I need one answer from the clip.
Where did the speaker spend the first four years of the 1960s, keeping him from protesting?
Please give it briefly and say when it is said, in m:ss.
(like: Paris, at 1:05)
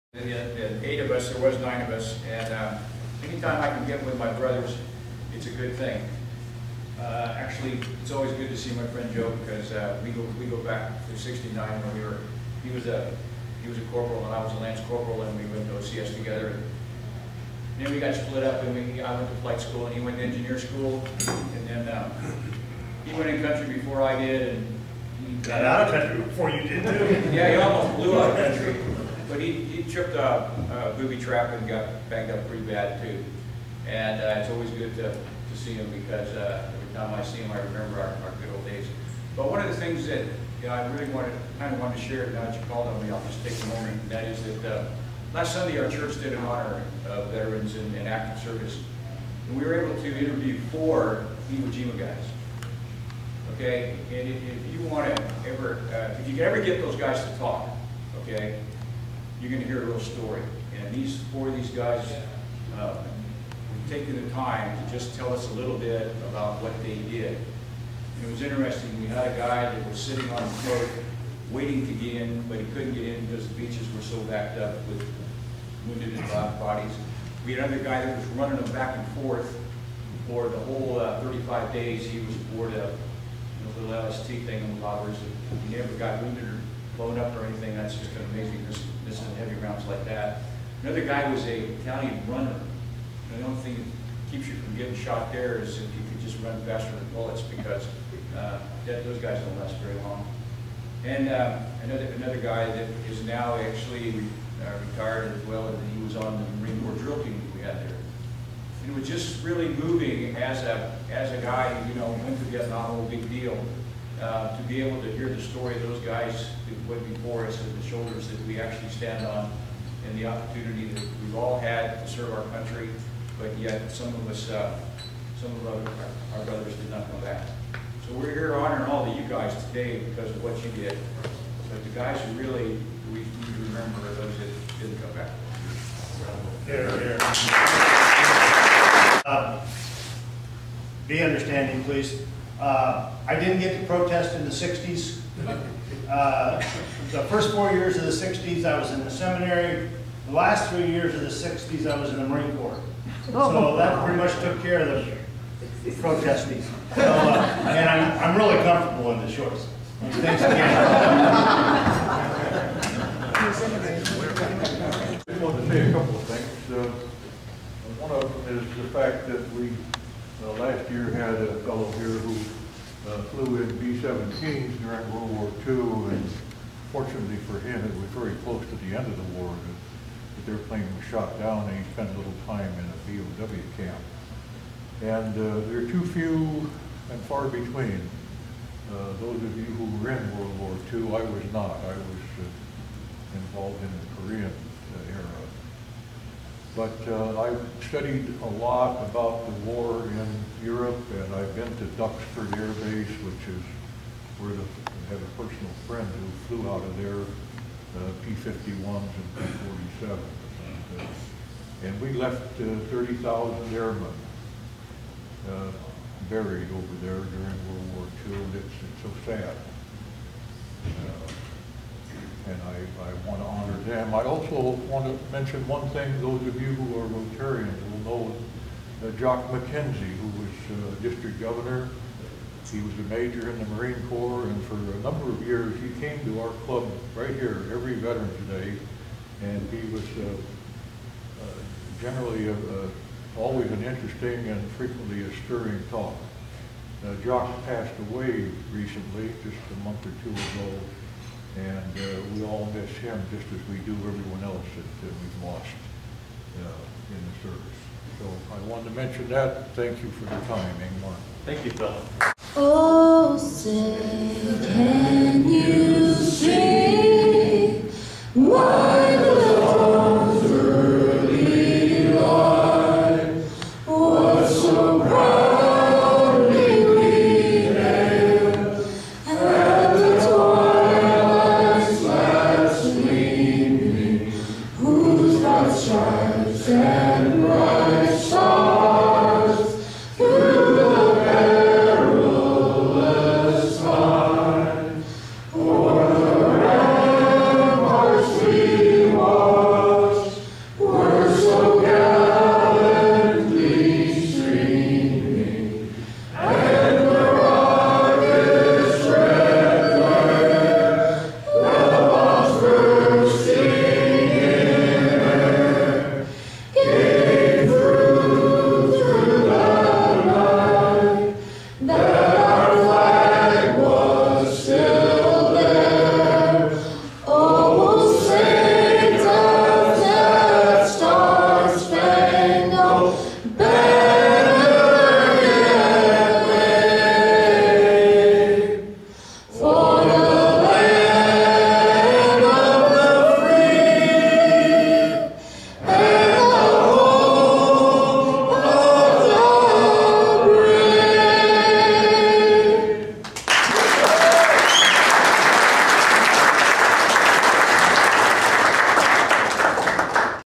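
The seminary, at 2:29.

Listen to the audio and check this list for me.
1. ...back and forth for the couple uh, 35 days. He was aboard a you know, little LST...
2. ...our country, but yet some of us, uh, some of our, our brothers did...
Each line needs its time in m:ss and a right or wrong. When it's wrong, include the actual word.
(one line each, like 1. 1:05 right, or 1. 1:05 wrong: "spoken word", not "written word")
1. 1:18 wrong: "whole", not "couple"
2. 2:02 right.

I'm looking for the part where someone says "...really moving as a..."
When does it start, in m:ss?
1:49.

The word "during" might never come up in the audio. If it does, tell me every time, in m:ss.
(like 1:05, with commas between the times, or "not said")
2:54, 3:37.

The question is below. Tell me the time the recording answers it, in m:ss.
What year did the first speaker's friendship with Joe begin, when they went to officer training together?
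0:11.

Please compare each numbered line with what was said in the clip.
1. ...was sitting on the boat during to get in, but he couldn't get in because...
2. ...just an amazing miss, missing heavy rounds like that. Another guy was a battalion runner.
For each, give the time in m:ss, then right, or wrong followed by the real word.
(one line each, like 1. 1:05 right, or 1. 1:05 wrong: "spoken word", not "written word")
1. 1:09 wrong: "waiting", not "during"
2. 1:27 right.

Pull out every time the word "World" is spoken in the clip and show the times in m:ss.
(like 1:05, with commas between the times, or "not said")
2:55, 3:10, 3:37.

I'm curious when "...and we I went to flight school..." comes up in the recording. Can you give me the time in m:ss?
0:18.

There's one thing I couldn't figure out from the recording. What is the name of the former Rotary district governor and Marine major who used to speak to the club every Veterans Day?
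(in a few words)
Jock McKenzie.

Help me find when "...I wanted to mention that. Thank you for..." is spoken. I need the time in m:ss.
4:18.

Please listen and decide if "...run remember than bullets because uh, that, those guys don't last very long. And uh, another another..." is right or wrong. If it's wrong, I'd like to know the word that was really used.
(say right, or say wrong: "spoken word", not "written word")
wrong: "faster", not "remember".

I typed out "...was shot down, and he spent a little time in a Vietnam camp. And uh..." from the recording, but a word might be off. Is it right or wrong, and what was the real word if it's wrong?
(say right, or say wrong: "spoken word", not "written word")
wrong: "POW", not "Vietnam".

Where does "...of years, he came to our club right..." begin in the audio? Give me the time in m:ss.
3:55.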